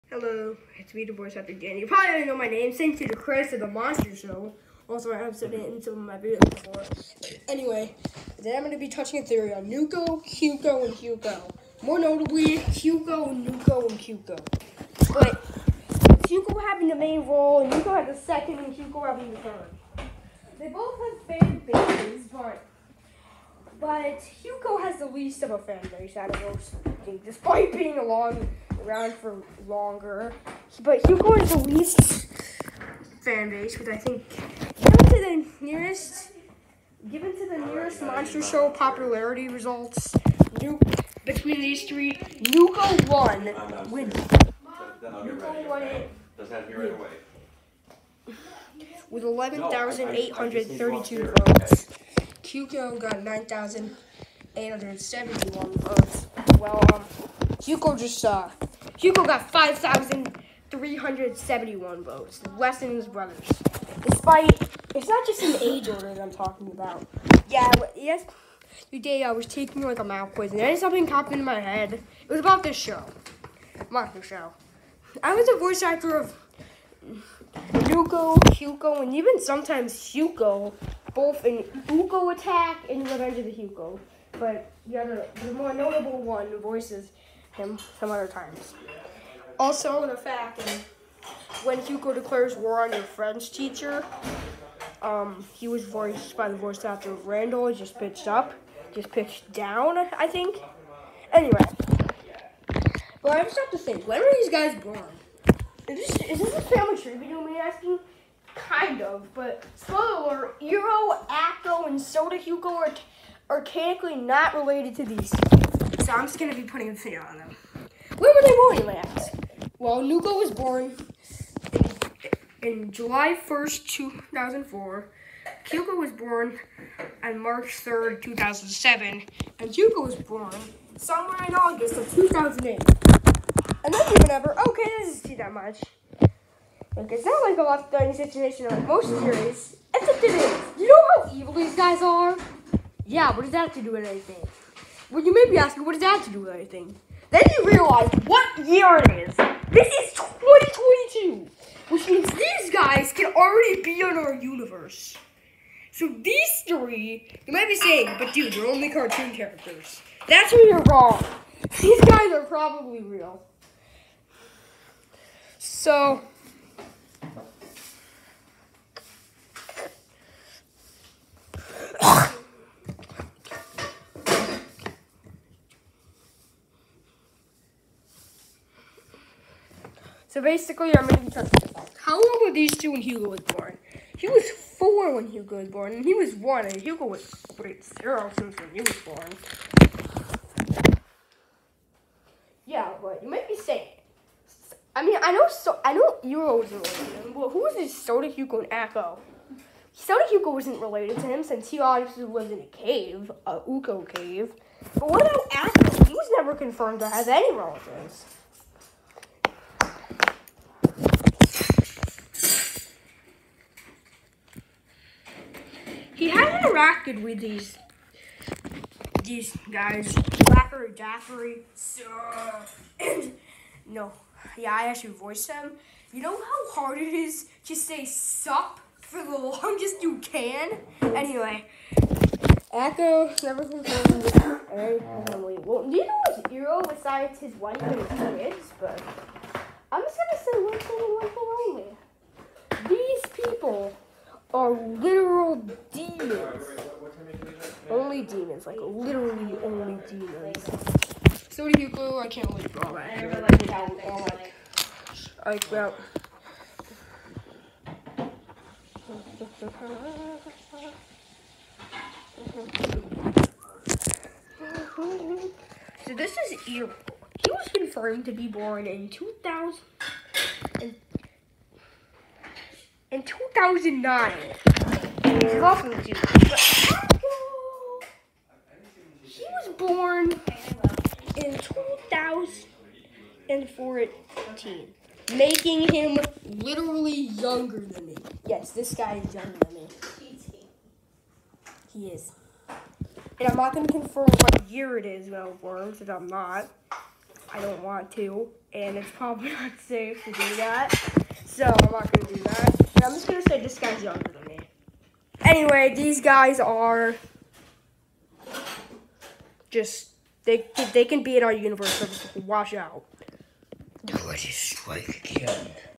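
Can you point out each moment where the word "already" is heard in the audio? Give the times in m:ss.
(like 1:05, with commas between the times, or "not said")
0:02, 2:33.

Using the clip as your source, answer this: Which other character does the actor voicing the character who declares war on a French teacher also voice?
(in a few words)
Randall.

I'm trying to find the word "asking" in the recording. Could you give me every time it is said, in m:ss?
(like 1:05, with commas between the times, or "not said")
1:47, 2:25.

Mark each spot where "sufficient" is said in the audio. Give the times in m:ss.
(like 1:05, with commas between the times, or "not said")
not said.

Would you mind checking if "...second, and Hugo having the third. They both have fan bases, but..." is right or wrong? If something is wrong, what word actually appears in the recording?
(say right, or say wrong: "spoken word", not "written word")
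right.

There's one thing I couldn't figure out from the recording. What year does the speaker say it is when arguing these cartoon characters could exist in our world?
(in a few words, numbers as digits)
2022.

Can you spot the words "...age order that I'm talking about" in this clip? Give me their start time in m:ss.
1:05.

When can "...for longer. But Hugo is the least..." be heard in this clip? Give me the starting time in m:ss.
0:29.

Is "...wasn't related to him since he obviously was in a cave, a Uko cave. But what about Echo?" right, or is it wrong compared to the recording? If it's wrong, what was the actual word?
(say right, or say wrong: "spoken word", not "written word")
right.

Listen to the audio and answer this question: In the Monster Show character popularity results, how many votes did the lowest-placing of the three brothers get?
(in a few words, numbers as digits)
5,371.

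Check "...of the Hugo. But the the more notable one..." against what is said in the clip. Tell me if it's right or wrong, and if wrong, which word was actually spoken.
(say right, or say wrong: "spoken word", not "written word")
right.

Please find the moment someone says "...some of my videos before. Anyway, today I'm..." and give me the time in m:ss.
0:05.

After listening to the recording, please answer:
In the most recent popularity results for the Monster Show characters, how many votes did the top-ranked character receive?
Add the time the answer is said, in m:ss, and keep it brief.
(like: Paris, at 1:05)
11,832, at 0:49.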